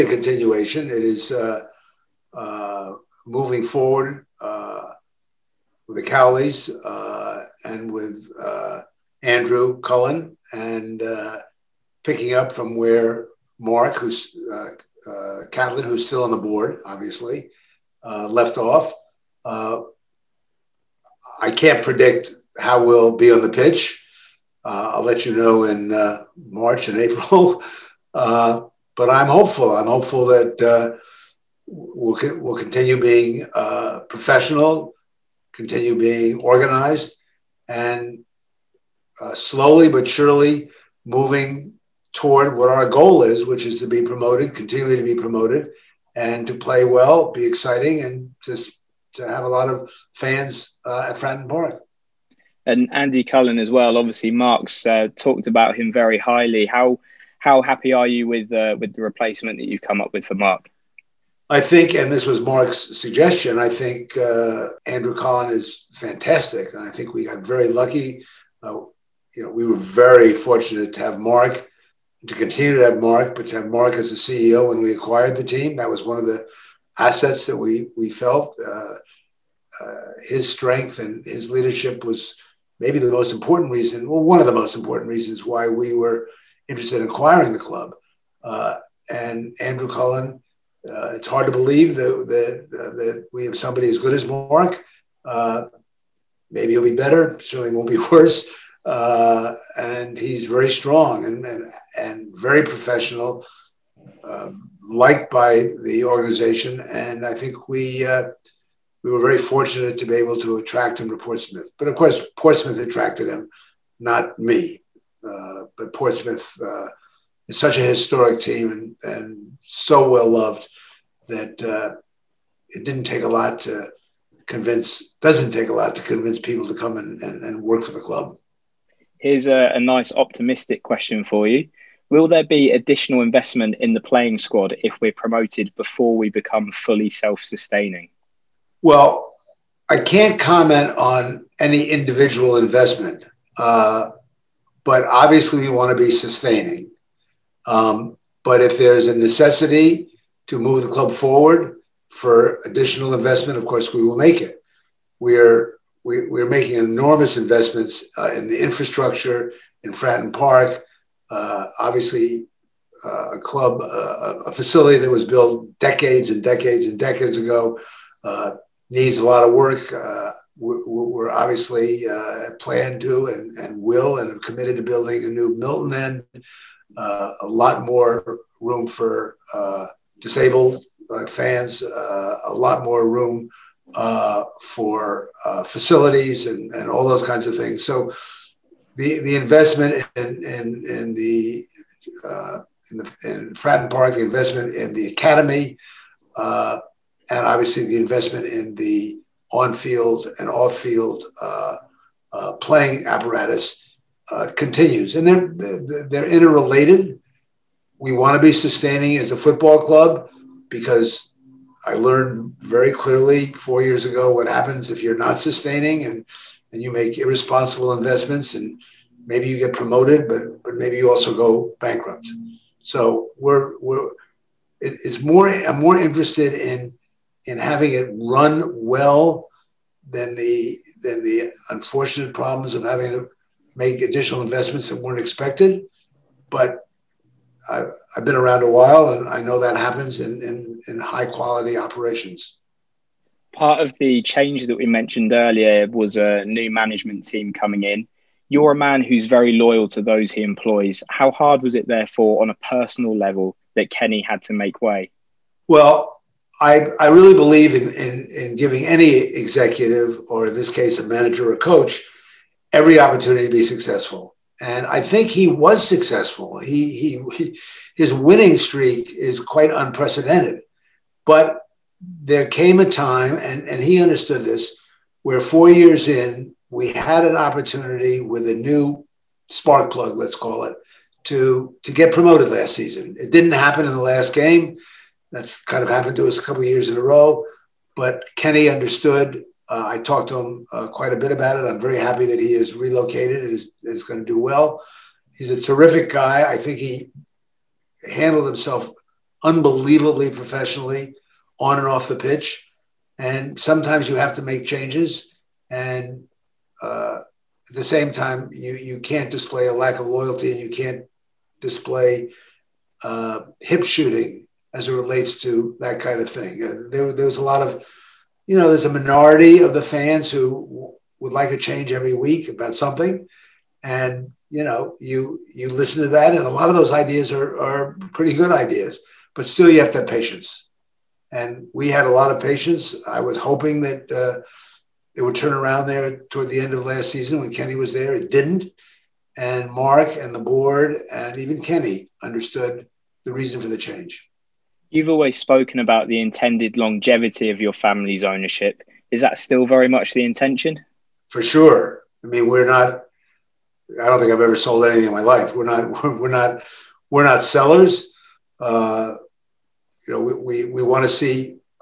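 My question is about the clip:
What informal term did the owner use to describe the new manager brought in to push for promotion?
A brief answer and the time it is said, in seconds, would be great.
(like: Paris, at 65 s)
spark plug, at 279 s.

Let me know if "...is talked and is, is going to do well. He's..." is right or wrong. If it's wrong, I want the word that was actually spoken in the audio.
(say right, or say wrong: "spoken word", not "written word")
wrong: "relocated", not "talked".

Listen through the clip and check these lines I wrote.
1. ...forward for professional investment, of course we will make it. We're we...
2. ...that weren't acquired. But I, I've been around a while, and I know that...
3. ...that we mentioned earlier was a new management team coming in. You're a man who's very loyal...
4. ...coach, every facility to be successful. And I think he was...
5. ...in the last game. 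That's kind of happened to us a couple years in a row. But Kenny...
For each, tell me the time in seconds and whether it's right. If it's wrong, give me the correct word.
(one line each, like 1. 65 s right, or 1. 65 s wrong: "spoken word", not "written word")
1. 151 s wrong: "additional", not "professional"
2. 234 s wrong: "expected", not "acquired"
3. 244 s right
4. 261 s wrong: "opportunity", not "facility"
5. 283 s right.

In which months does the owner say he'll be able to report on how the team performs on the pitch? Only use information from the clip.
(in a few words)
March and April.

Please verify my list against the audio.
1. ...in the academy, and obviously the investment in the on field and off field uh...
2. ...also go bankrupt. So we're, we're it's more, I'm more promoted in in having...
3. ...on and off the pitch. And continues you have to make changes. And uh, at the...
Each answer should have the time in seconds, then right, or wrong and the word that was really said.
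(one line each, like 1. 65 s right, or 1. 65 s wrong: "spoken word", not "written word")
1. 194 s right
2. 221 s wrong: "interested", not "promoted"
3. 301 s wrong: "sometimes", not "continues".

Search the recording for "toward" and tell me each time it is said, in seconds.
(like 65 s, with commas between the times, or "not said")
42 s, 336 s.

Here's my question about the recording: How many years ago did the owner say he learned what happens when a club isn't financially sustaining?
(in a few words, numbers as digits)
4.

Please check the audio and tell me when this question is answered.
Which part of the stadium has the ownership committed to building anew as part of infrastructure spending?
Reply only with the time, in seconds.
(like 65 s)
175 s.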